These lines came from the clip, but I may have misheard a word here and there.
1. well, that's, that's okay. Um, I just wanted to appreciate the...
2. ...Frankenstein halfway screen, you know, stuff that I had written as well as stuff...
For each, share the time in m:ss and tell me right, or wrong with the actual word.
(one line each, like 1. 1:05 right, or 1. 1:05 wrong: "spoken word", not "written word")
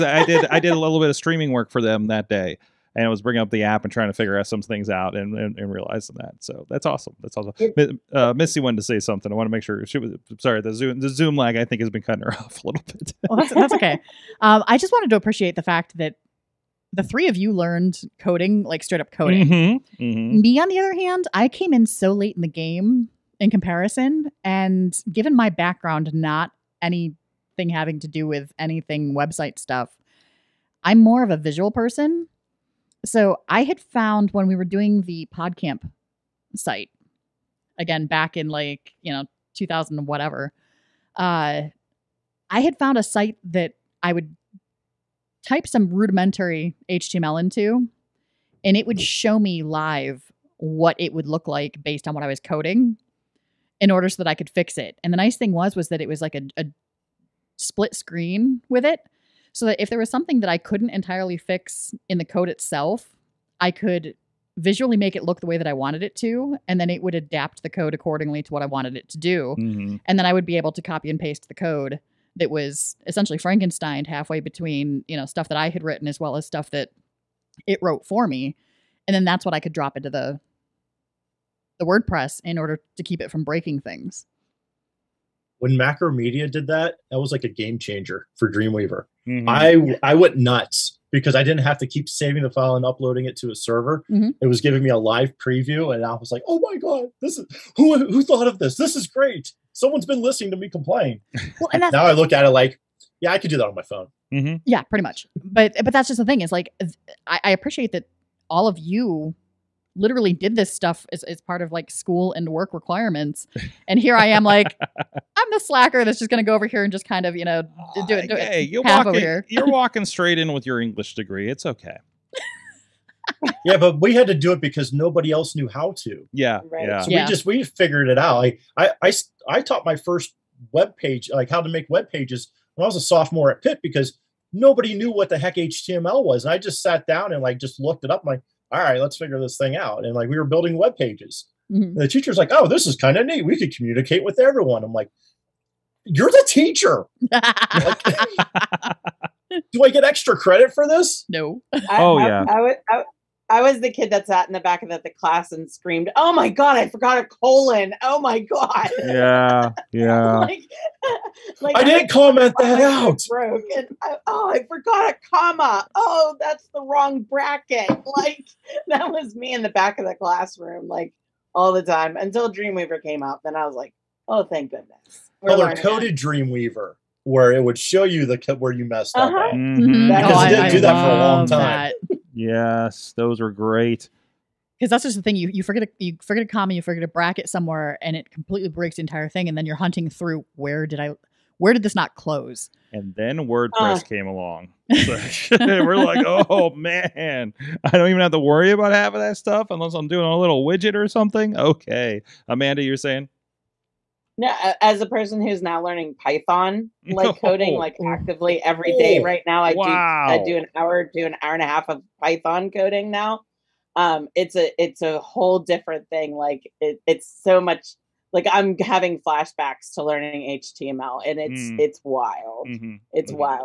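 1. 0:13 right
2. 1:13 wrong: "between", not "screen".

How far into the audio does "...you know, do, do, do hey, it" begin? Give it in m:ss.
1:57.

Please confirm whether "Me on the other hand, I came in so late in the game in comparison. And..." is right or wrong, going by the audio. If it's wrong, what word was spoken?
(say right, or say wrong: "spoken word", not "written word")
right.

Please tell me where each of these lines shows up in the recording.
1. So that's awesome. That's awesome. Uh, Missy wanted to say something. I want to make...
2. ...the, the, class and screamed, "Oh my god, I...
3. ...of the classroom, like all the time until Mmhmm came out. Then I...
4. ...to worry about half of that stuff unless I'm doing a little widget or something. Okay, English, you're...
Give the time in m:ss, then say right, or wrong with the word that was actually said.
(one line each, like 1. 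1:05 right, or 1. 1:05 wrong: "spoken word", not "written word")
1. 0:06 right
2. 2:34 right
3. 2:49 wrong: "Dreamweaver", not "Mmhmm"
4. 3:18 wrong: "Amanda", not "English".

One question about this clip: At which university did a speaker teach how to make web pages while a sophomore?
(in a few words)
Pitt.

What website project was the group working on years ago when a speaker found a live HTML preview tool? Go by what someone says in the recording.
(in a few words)
PodCamp.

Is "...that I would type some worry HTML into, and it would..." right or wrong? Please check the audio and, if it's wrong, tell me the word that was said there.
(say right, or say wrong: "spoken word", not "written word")
wrong: "rudimentary", not "worry".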